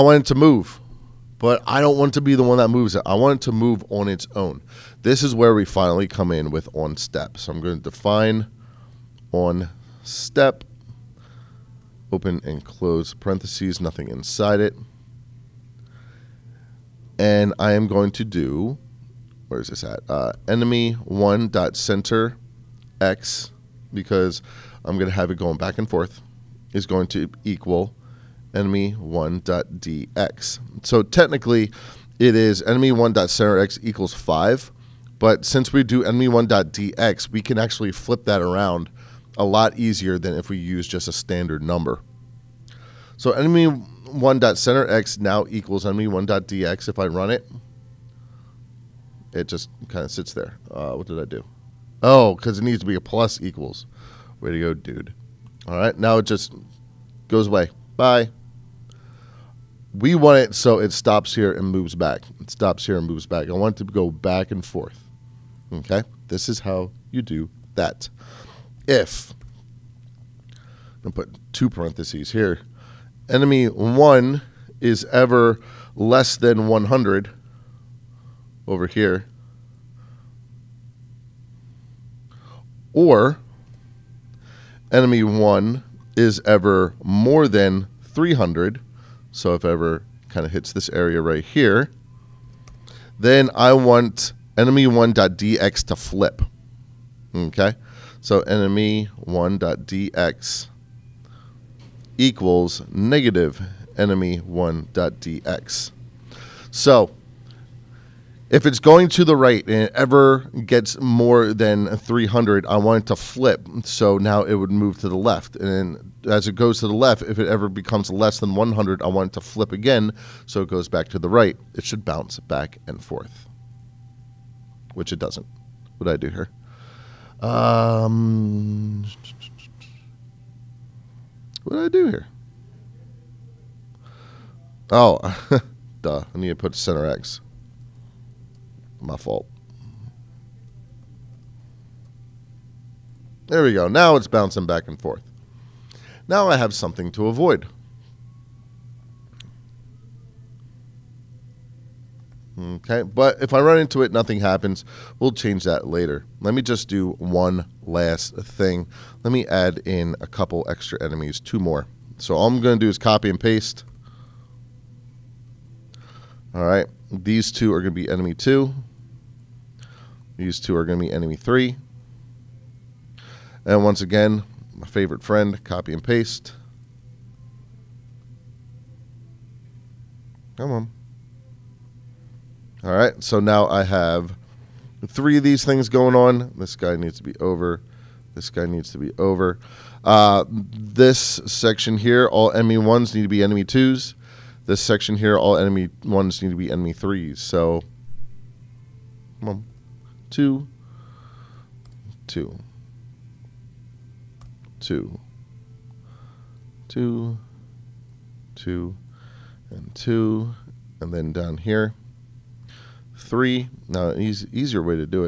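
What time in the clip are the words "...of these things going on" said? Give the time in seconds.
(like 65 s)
185 s.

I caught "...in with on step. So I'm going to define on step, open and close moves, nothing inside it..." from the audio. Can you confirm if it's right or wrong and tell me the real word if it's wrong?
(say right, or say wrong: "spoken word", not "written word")
wrong: "parentheses", not "moves".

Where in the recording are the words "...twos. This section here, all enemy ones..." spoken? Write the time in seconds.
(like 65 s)
193 s.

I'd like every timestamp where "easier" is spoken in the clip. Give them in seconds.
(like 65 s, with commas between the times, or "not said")
39 s, 214 s.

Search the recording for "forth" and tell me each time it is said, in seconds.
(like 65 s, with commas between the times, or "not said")
25 s, 64 s, 123 s, 145 s.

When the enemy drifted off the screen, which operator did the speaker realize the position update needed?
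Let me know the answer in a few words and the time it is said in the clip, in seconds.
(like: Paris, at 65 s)
plus equals, at 52 s.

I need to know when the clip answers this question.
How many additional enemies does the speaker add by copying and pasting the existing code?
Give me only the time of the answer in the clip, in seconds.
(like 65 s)
161 s.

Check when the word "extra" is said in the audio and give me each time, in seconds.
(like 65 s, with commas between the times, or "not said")
160 s.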